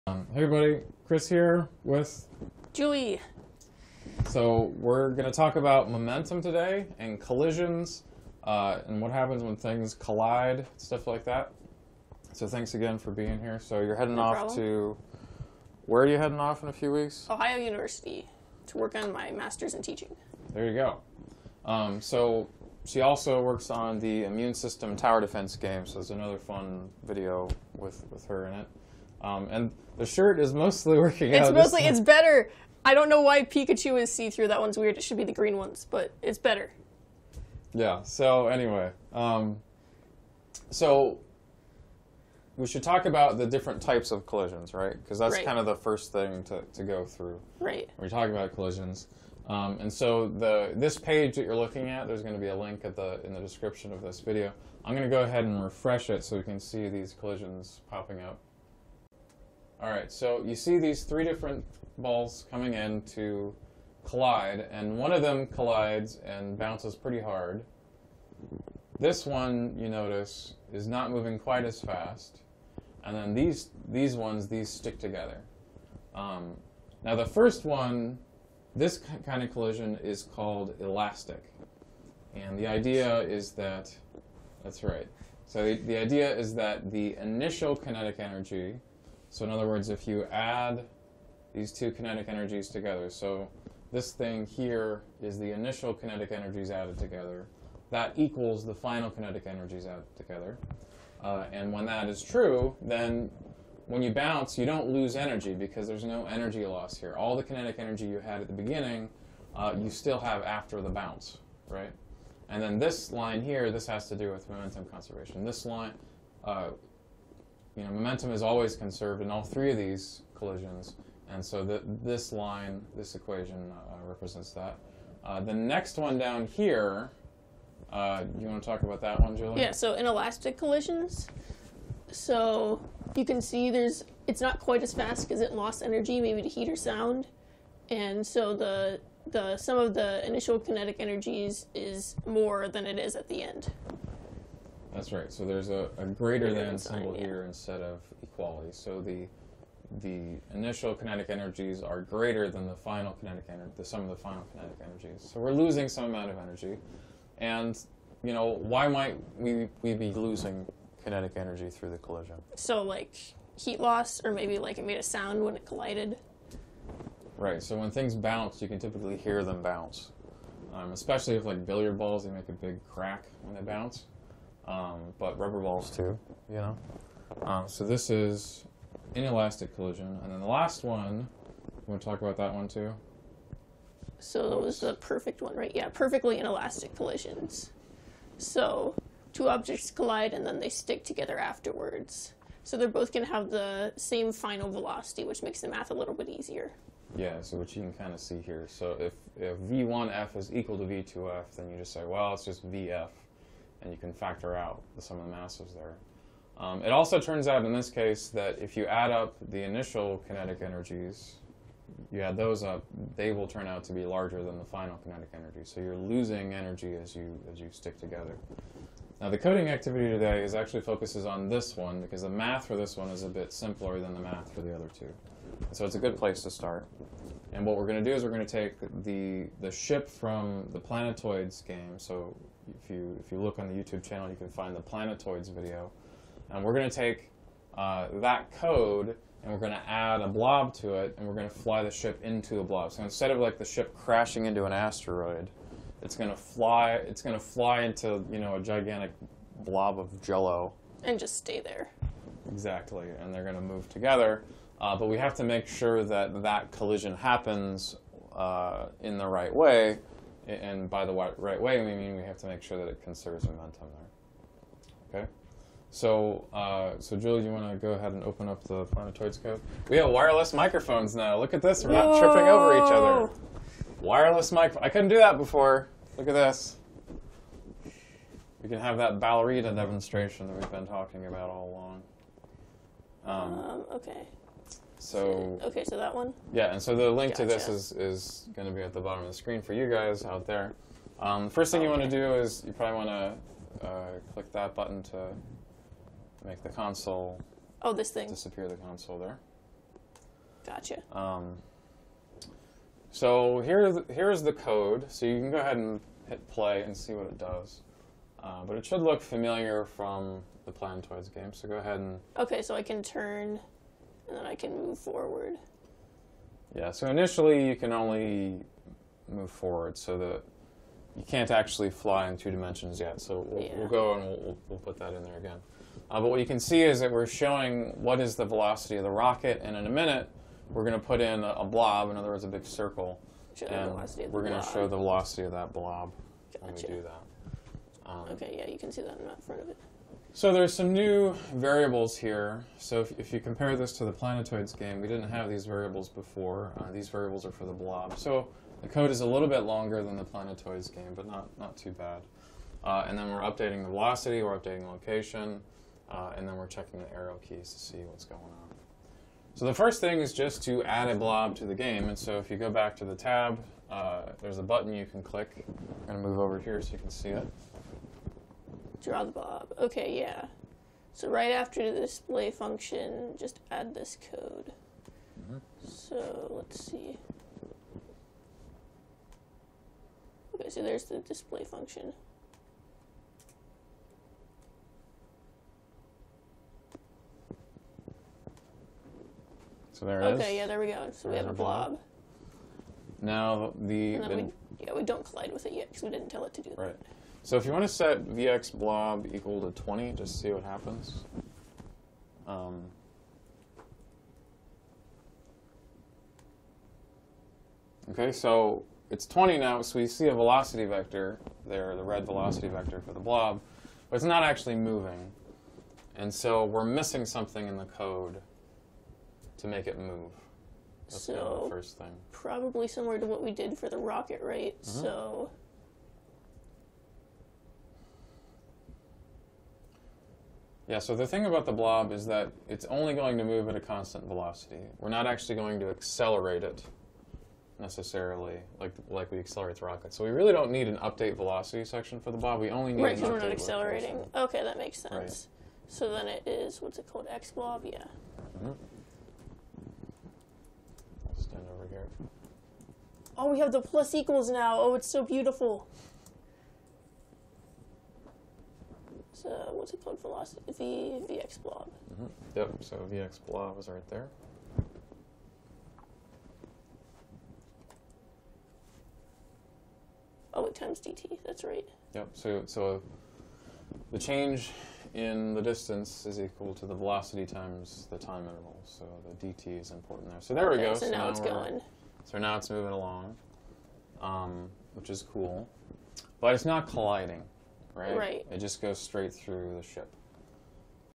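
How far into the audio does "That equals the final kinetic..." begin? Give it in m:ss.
1:37.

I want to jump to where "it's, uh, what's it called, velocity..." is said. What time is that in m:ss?
7:39.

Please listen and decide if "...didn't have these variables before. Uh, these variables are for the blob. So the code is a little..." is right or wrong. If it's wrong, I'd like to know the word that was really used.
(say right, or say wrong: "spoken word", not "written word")
right.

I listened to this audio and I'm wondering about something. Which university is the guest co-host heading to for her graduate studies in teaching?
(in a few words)
Ohio University.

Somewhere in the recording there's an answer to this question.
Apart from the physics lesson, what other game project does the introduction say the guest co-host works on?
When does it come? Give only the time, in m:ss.
0:24.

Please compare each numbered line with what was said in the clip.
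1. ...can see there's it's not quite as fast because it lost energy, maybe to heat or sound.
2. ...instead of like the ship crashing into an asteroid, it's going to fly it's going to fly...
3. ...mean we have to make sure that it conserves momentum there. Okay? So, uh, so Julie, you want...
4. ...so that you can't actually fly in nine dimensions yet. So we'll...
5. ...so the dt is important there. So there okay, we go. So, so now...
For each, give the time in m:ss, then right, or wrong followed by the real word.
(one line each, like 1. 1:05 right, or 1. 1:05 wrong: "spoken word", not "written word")
1. 2:13 right
2. 4:03 right
3. 4:21 right
4. 5:19 wrong: "two", not "nine"
5. 7:58 right.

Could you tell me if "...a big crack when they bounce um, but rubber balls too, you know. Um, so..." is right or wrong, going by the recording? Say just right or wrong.
right.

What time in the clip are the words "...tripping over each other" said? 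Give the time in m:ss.
4:32.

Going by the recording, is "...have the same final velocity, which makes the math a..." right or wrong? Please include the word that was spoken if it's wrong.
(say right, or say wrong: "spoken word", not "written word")
right.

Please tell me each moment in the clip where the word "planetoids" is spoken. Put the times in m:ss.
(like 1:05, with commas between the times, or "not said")
3:50, 3:54, 4:28, 5:10, 5:44, 5:50.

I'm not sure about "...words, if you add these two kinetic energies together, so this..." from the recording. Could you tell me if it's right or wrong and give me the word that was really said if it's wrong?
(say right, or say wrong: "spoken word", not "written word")
right.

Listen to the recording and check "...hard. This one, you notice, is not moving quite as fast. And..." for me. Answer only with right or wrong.
right.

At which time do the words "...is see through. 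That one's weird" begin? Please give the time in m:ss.
0:34.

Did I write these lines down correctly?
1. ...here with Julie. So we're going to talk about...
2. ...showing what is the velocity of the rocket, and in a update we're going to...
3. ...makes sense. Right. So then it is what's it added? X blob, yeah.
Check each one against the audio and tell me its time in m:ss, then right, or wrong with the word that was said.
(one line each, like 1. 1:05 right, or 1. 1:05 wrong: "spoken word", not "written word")
1. 0:01 right
2. 5:27 wrong: "minute", not "update"
3. 7:24 wrong: "called", not "added".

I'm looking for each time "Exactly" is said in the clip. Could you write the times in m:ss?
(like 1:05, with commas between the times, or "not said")
4:12.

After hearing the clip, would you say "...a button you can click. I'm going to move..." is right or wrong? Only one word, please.
right.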